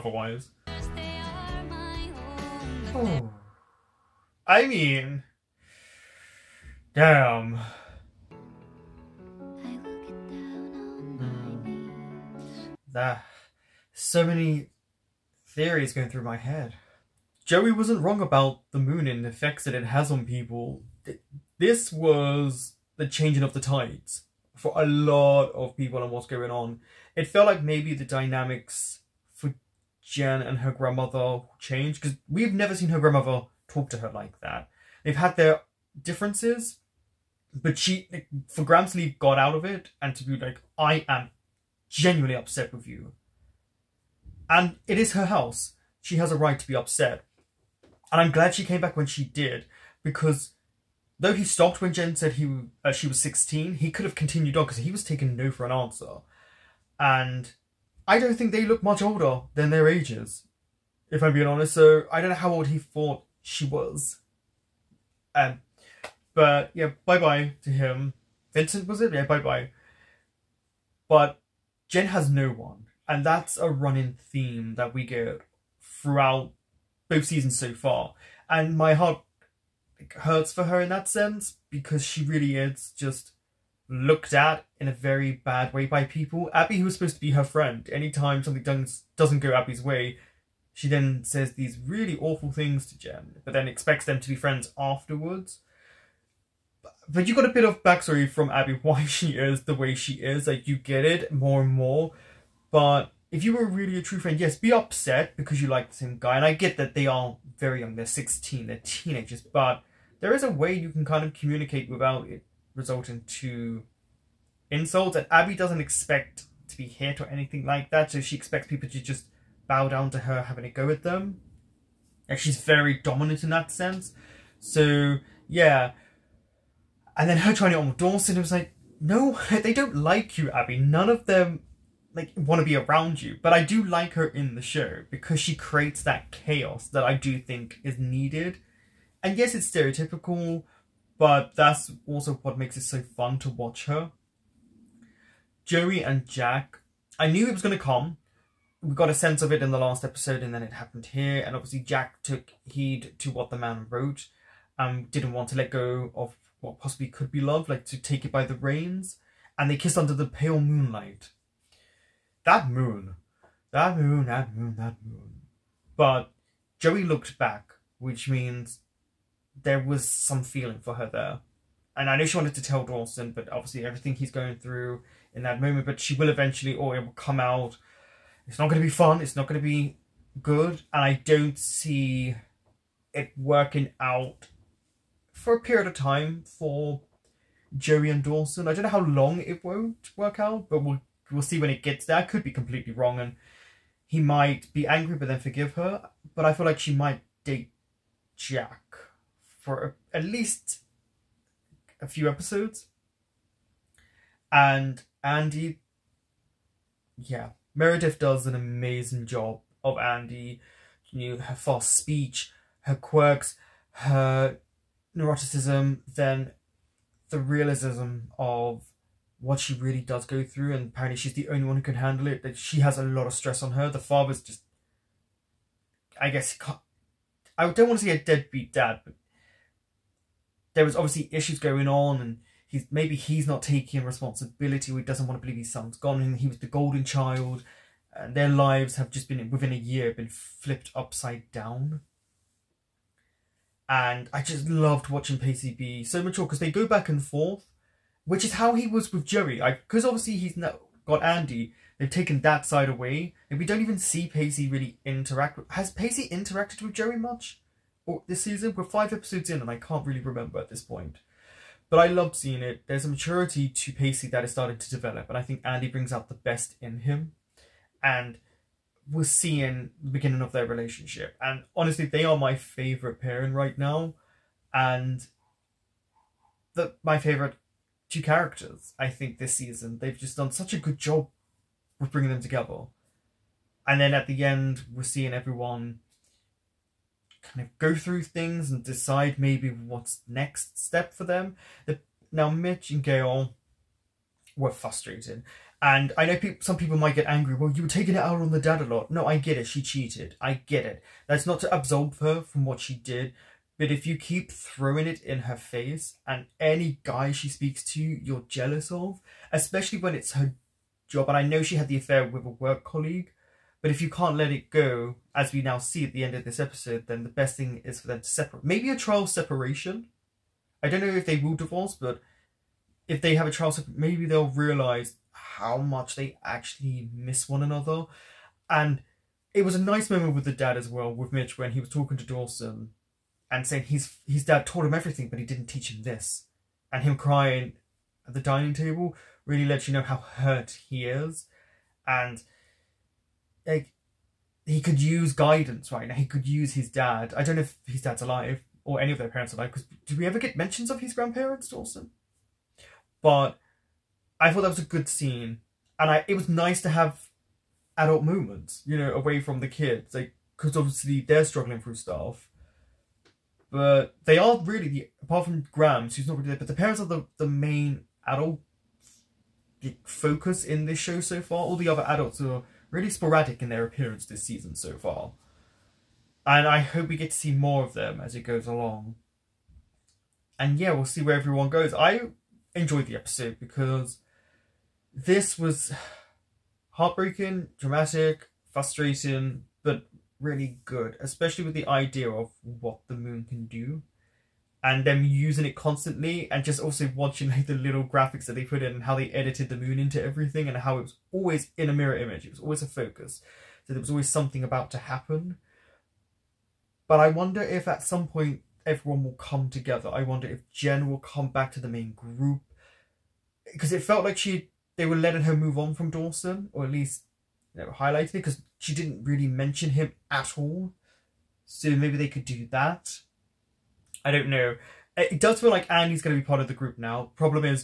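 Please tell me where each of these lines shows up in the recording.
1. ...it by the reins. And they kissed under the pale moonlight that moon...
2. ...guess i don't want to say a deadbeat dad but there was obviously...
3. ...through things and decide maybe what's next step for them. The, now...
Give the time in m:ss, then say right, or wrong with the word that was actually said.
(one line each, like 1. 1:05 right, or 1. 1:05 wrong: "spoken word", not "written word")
1. 2:38 right
2. 3:46 right
3. 4:47 right.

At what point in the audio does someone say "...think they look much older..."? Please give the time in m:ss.
0:58.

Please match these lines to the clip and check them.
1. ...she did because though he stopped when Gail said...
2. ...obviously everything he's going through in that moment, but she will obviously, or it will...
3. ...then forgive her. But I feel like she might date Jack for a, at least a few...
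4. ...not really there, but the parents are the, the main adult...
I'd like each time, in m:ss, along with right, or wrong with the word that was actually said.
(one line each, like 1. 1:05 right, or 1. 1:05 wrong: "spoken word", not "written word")
1. 0:49 wrong: "Jen", not "Gail"
2. 2:53 wrong: "eventually", not "obviously"
3. 3:15 right
4. 6:06 right.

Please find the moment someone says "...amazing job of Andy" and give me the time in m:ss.
3:28.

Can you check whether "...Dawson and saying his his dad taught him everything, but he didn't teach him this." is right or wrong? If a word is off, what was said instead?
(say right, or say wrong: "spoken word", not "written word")
right.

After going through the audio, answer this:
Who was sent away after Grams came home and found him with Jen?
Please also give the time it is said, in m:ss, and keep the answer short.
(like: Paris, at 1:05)
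Vincent, at 1:08.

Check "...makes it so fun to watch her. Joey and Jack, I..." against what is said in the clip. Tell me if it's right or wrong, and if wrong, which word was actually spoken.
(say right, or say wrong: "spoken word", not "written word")
right.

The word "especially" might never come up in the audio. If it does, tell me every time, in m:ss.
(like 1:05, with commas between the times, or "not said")
5:09, 6:31.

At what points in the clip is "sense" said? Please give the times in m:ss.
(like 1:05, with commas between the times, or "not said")
1:21, 2:03, 2:29.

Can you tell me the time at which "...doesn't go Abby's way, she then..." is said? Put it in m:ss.
1:29.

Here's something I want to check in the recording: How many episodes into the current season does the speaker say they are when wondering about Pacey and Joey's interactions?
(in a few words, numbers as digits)
5.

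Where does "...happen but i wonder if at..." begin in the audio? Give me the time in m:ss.
6:44.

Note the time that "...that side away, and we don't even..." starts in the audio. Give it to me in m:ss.
4:12.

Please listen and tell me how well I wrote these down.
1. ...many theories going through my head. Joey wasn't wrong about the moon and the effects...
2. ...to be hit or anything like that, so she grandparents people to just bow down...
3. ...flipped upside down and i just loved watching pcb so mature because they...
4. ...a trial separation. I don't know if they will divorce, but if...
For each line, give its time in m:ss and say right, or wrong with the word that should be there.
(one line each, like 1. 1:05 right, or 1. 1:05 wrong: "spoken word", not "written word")
1. 0:14 right
2. 1:56 wrong: "expects", not "grandparents"
3. 4:00 right
4. 5:18 right.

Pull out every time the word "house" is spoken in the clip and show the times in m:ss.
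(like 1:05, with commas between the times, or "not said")
0:45.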